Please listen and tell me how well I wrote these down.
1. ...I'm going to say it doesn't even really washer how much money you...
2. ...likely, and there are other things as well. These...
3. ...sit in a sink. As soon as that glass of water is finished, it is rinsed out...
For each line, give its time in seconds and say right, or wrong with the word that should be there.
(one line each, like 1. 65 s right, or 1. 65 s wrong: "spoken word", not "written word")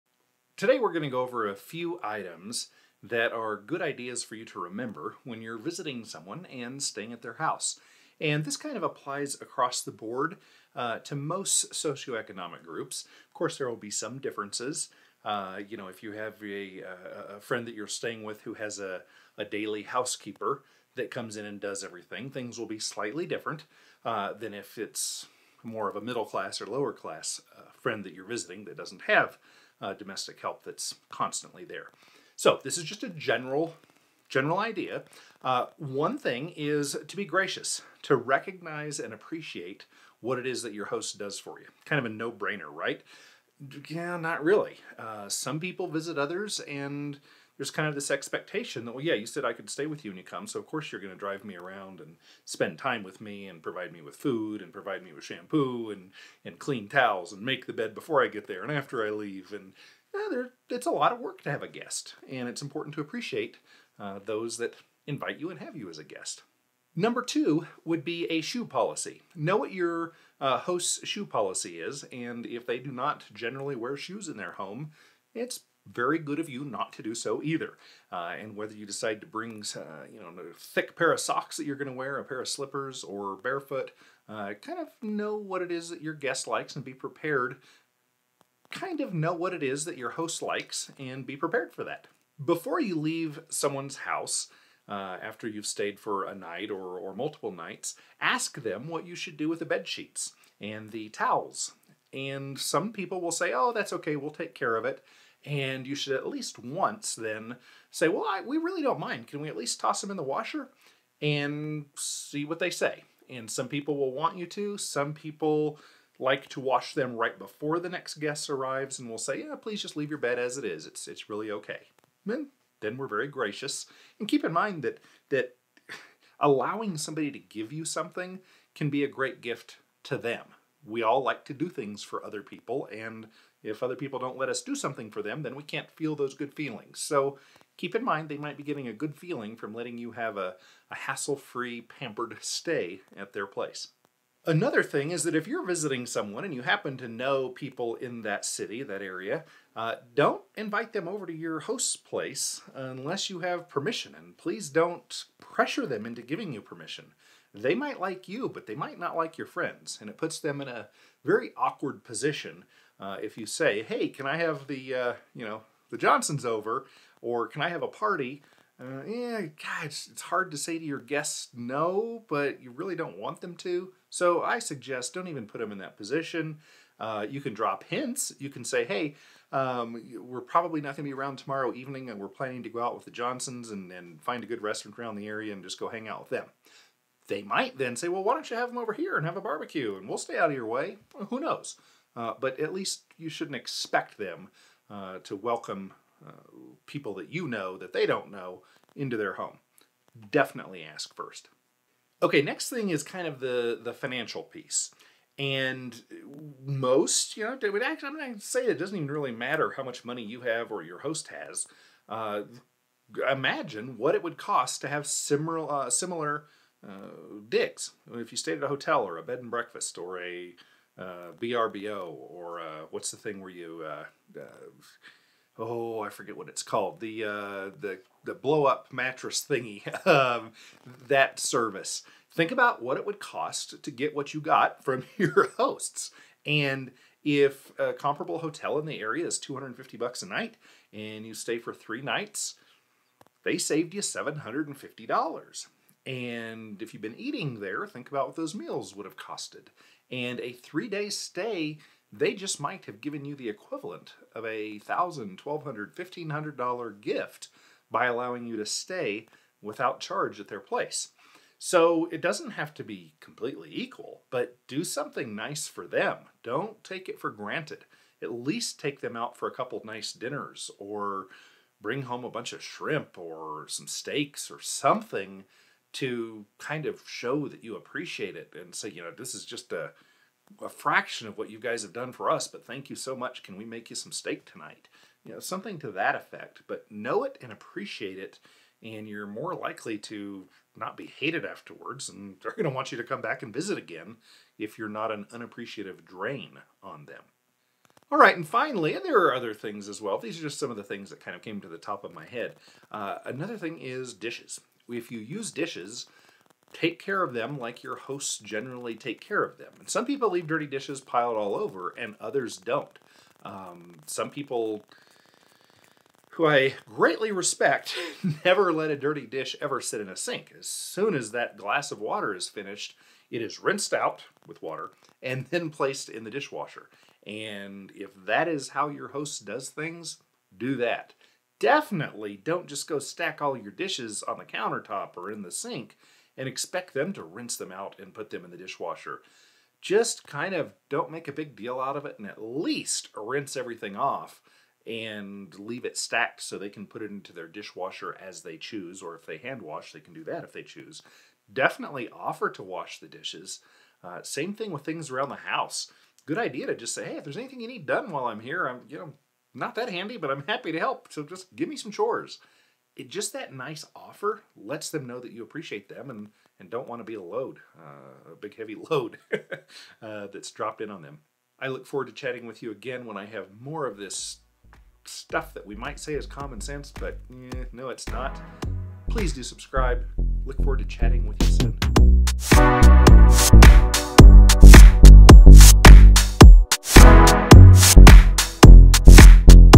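1. 208 s wrong: "matter", not "washer"
2. 298 s wrong: "finally", not "likely"
3. 319 s right.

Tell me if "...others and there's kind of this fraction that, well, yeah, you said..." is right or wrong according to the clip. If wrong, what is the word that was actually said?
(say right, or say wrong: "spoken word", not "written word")
wrong: "expectation", not "fraction".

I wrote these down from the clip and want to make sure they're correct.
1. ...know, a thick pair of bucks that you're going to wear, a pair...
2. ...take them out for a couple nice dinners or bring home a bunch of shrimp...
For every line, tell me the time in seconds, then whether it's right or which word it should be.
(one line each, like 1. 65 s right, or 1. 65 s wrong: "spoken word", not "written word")
1. 80 s wrong: "socks", not "bucks"
2. 268 s right.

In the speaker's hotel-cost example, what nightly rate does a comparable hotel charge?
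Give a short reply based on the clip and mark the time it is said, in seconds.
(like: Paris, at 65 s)
$250, at 239 s.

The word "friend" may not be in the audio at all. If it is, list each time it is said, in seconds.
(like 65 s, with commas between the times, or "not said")
17 s, 27 s, 159 s.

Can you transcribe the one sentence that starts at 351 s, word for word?
Definitely offer to wash the dishes.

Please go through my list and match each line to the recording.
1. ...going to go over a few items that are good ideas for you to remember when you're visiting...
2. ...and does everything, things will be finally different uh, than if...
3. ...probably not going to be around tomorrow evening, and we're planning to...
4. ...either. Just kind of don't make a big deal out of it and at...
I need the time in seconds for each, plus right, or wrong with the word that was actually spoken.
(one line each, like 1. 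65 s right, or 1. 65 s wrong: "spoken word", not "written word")
1. 0 s right
2. 21 s wrong: "slightly", not "finally"
3. 180 s right
4. 338 s wrong: "dishwasher", not "either".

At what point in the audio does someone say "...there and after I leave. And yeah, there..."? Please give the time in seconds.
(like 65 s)
58 s.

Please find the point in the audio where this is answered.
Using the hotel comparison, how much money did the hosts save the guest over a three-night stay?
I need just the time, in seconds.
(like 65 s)
244 s.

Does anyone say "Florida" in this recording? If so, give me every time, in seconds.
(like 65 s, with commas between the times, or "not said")
not said.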